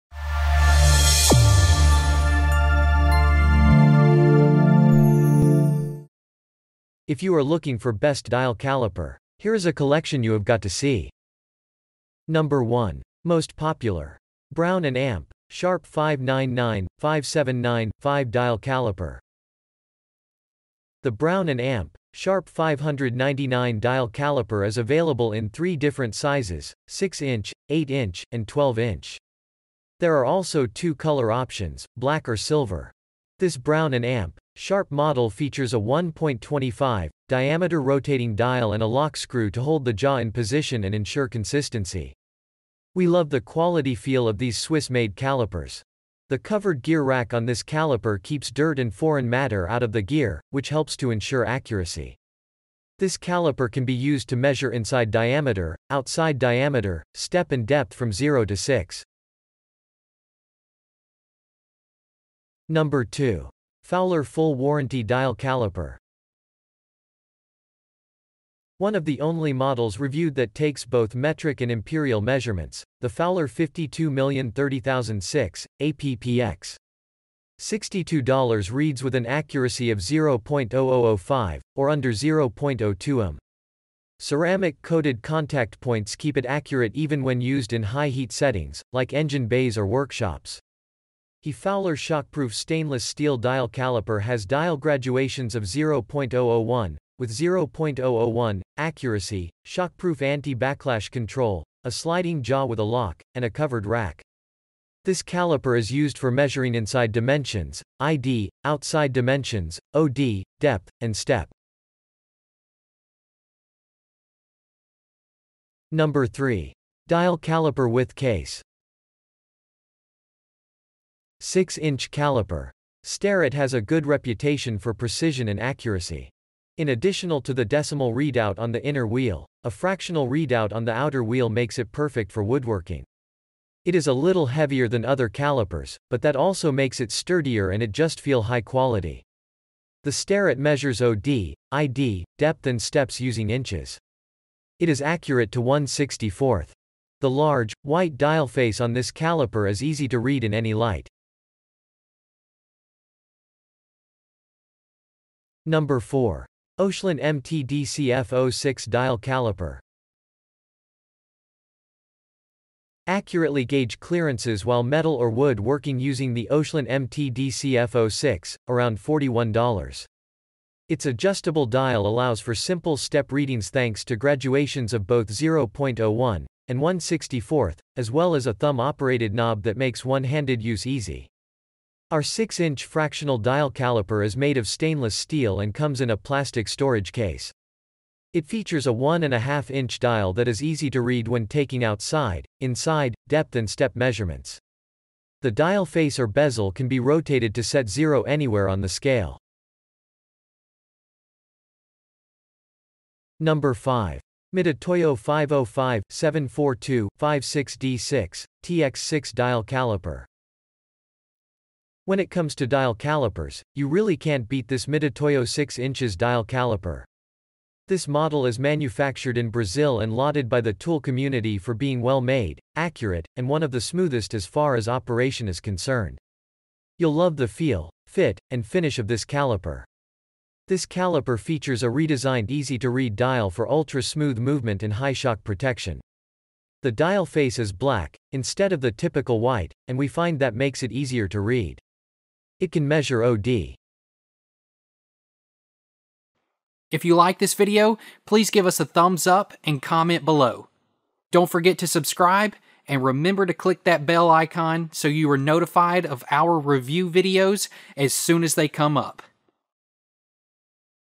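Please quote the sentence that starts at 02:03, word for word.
Starrett has a good reputation for precision and accuracy.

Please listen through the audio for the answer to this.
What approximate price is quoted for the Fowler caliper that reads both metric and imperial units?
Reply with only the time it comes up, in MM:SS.
01:17.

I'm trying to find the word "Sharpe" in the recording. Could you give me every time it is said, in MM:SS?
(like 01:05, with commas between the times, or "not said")
00:15, 00:22, 00:34.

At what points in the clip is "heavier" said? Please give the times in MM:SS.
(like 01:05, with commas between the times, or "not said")
02:14.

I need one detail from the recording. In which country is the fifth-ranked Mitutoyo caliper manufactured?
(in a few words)
Brazil.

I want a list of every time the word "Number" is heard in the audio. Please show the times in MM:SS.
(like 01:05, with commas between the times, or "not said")
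00:12, 01:02, 01:55, 02:35, 03:23.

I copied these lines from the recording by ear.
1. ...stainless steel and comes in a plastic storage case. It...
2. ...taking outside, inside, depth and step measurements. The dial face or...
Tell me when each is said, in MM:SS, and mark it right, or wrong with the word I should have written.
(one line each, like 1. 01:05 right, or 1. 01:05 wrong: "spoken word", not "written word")
1. 03:04 right
2. 03:11 right.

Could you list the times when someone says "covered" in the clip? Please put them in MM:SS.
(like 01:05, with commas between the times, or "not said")
00:46, 01:43.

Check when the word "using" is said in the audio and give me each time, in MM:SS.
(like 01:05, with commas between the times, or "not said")
02:23, 02:45.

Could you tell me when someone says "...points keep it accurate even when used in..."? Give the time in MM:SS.
01:25.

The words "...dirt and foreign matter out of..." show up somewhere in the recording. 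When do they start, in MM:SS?
00:48.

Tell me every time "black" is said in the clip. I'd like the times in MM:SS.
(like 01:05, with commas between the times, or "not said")
00:31, 03:57.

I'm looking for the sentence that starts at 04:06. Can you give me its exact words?
If you like this video, please give us a thumbs up and comment below.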